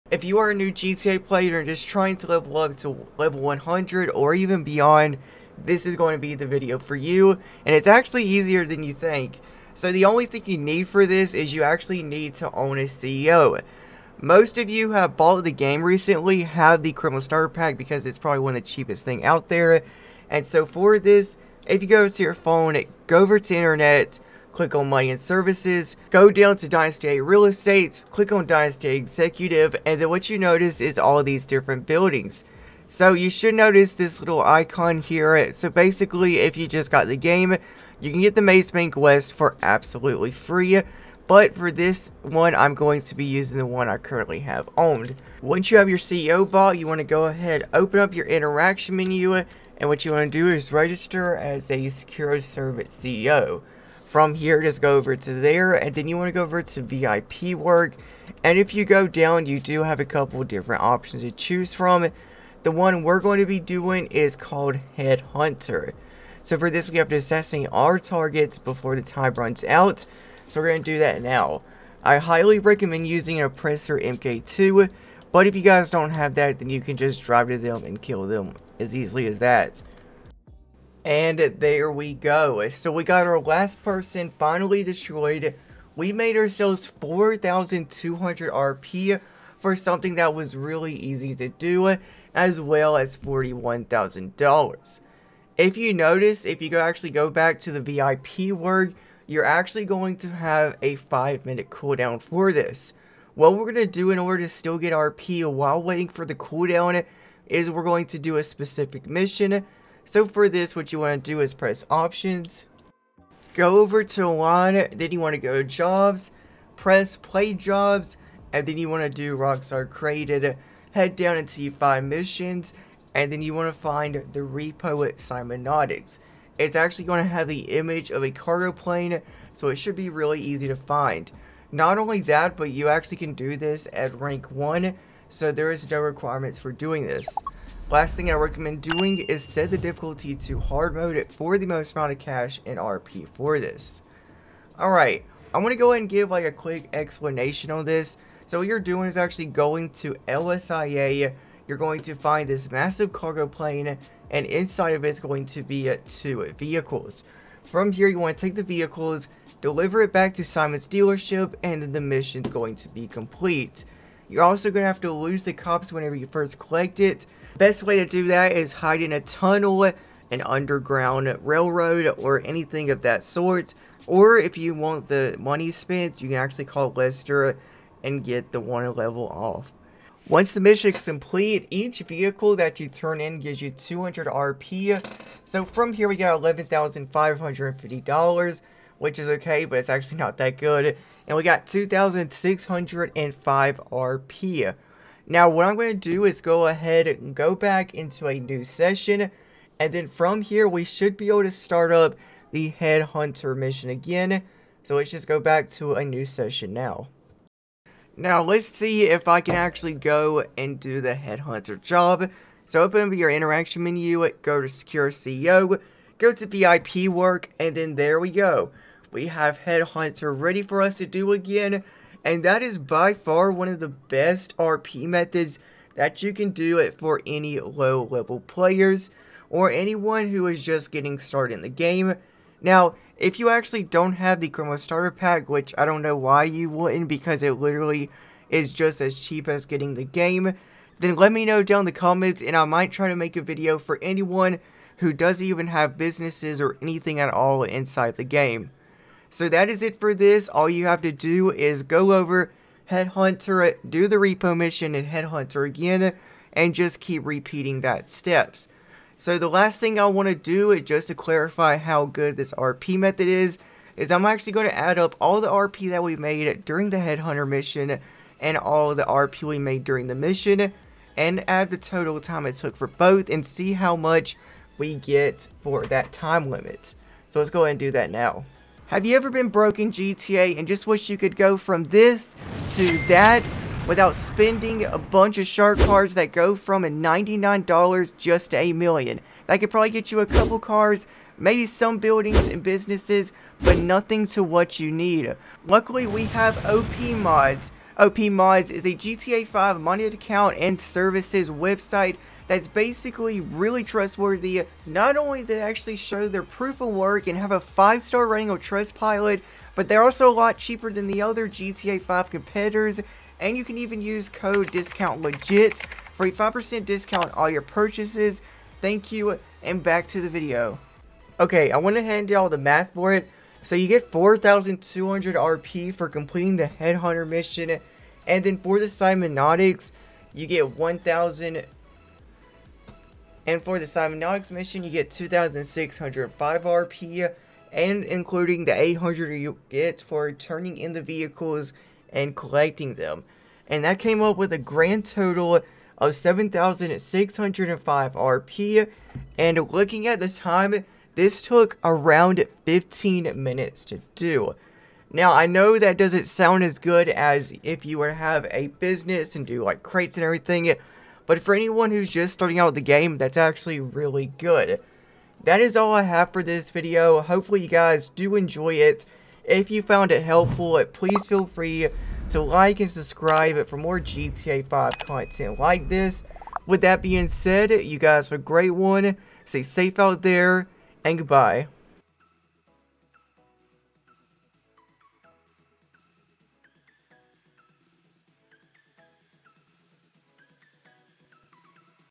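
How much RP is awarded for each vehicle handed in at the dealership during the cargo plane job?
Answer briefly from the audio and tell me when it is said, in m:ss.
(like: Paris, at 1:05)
200 RP, at 3:03.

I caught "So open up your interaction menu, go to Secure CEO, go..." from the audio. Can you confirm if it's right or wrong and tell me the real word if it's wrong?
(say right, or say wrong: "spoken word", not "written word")
right.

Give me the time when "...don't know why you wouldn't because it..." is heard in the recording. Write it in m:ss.
3:55.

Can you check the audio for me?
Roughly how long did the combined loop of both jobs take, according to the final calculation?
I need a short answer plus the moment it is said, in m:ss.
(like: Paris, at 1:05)
15 minutes, at 5:52.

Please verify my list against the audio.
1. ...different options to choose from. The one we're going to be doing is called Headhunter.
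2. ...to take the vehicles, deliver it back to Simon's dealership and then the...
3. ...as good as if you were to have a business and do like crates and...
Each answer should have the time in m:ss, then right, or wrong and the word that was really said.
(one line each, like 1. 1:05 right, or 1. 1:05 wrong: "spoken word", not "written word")
1. 1:00 right
2. 2:38 right
3. 5:56 right.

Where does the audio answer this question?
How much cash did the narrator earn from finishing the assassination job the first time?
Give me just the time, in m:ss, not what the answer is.
1:33.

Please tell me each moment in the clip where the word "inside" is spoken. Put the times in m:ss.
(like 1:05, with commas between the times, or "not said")
2:34, 4:07.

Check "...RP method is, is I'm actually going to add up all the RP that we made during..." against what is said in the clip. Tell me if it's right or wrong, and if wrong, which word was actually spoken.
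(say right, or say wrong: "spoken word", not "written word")
right.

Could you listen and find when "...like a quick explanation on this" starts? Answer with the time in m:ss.
2:26.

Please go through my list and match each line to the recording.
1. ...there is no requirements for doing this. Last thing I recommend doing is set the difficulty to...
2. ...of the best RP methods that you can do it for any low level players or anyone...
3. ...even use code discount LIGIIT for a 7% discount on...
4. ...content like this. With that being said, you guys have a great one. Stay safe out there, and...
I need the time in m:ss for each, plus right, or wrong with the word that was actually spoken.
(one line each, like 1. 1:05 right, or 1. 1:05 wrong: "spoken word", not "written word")
1. 2:15 right
2. 3:43 right
3. 5:13 wrong: "5", not "7"
4. 6:15 right.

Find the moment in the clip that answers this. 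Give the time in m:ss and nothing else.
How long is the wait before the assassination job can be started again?
1:40.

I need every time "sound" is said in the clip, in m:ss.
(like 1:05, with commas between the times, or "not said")
5:56.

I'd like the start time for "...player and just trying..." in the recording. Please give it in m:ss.
0:01.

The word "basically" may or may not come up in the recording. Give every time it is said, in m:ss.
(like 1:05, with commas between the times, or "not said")
0:35, 5:02.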